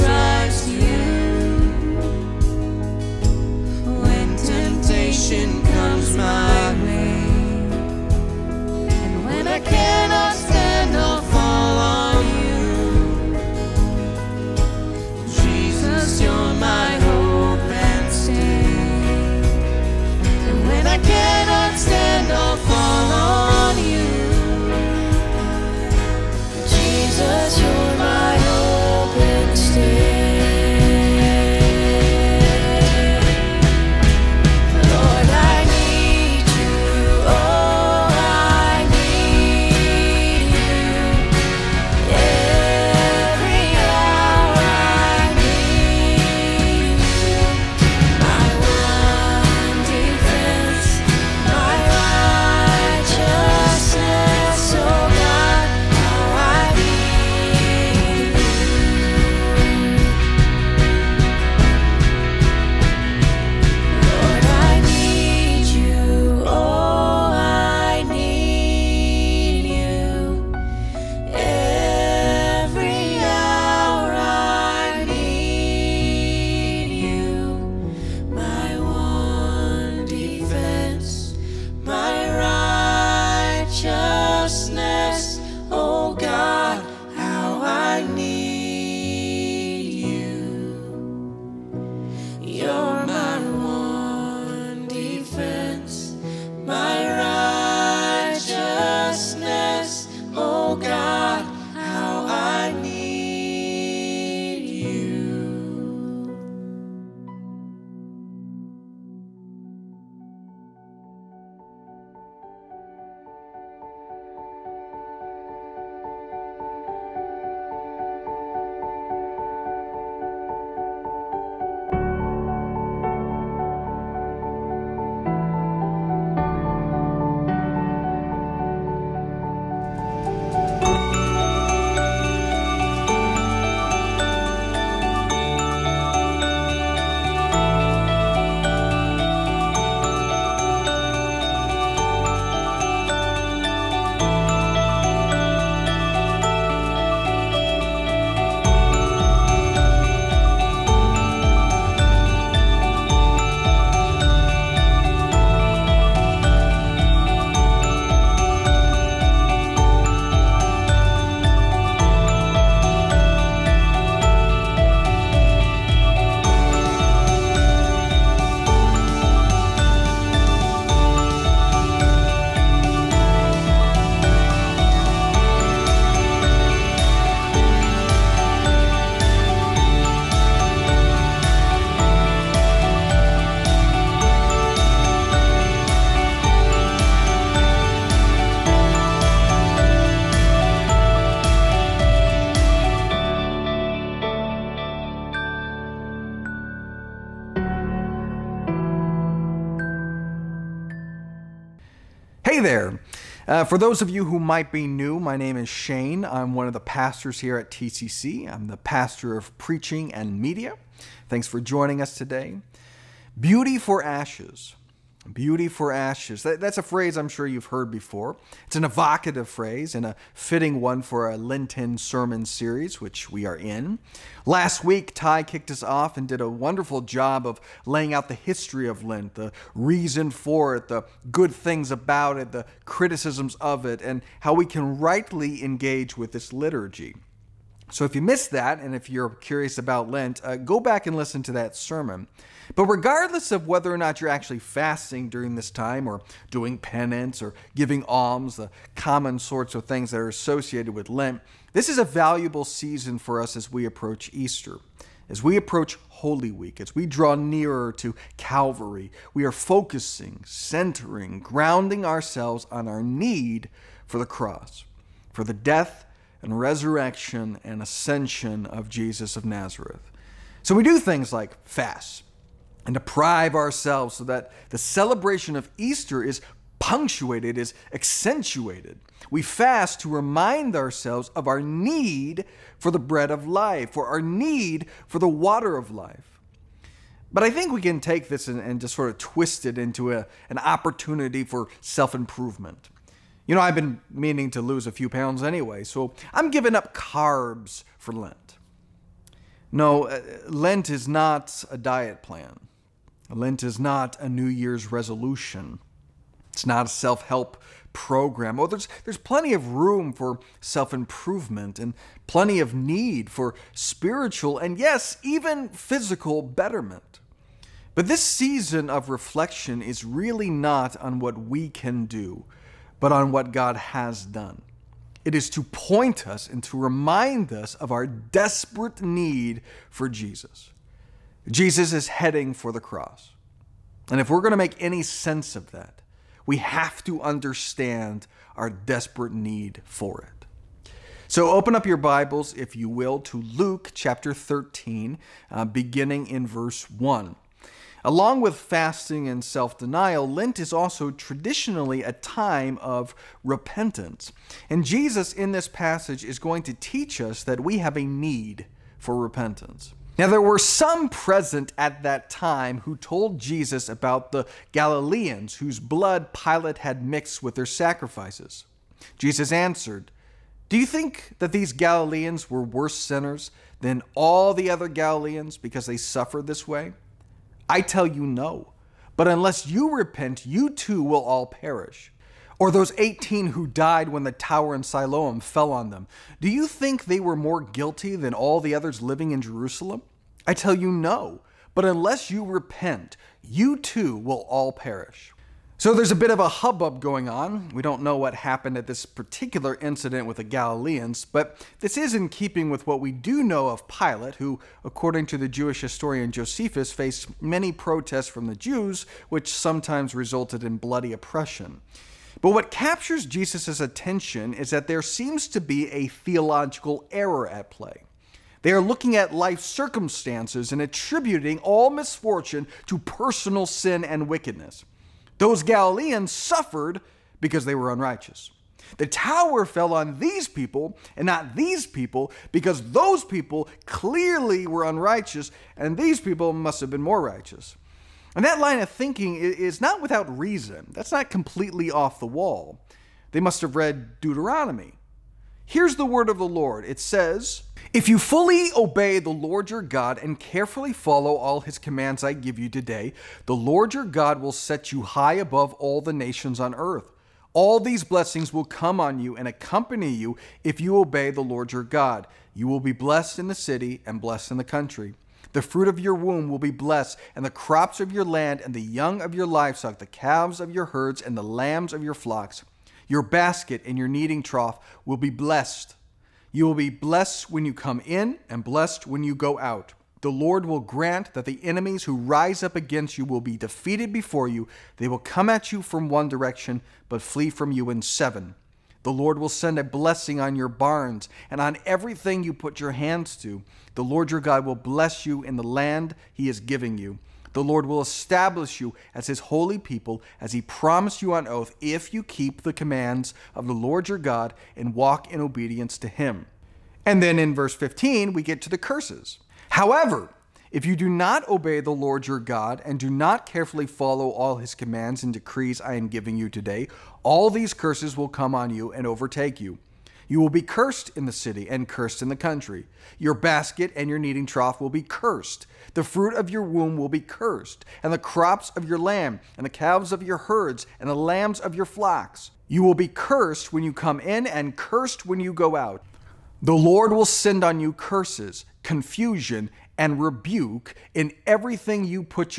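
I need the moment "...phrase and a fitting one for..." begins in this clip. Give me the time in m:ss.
3:39.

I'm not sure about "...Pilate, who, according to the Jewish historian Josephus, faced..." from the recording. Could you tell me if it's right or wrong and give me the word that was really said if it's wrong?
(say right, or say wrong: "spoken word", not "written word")
right.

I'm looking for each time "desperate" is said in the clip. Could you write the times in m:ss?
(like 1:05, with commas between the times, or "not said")
5:28, 5:38.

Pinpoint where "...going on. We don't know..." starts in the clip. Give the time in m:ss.
6:36.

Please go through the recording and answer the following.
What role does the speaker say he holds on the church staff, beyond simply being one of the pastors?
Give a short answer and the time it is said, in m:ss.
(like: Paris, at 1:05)
Pastor of preaching and media, at 3:28.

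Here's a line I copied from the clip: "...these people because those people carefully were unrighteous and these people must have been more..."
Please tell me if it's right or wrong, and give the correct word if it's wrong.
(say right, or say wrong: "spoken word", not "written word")
wrong: "clearly", not "carefully".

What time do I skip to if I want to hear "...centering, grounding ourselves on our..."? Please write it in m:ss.
4:20.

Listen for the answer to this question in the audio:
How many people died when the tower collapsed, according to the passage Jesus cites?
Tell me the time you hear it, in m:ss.
6:22.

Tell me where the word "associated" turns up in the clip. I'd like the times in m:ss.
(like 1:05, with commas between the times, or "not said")
4:10.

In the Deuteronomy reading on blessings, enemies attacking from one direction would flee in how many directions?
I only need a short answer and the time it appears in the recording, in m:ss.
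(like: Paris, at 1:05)
7, at 8:08.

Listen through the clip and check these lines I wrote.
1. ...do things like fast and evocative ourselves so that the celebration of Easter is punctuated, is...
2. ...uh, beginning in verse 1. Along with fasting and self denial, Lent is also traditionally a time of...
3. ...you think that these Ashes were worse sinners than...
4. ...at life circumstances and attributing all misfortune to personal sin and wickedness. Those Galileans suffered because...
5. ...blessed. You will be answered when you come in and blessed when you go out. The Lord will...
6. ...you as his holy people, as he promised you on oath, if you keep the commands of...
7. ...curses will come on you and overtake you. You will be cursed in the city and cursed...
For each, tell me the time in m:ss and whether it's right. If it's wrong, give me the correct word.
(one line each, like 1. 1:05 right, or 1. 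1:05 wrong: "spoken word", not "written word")
1. 4:30 wrong: "deprive", not "evocative"
2. 5:45 right
3. 6:10 wrong: "Galileans", not "Ashes"
4. 6:59 right
5. 7:55 wrong: "blessed", not "answered"
6. 8:18 right
7. 8:37 right.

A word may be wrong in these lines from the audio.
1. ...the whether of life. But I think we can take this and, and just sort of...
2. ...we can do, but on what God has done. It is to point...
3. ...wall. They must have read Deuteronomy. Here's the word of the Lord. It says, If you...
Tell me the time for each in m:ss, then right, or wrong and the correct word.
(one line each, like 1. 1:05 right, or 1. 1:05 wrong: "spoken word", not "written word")
1. 4:45 wrong: "water", not "whether"
2. 5:21 right
3. 7:22 right.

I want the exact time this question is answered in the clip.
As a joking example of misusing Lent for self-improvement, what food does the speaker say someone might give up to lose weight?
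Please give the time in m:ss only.
4:56.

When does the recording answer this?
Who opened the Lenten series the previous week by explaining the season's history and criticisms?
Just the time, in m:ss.
3:45.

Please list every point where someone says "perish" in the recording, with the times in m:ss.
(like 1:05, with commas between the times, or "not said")
6:21, 6:34.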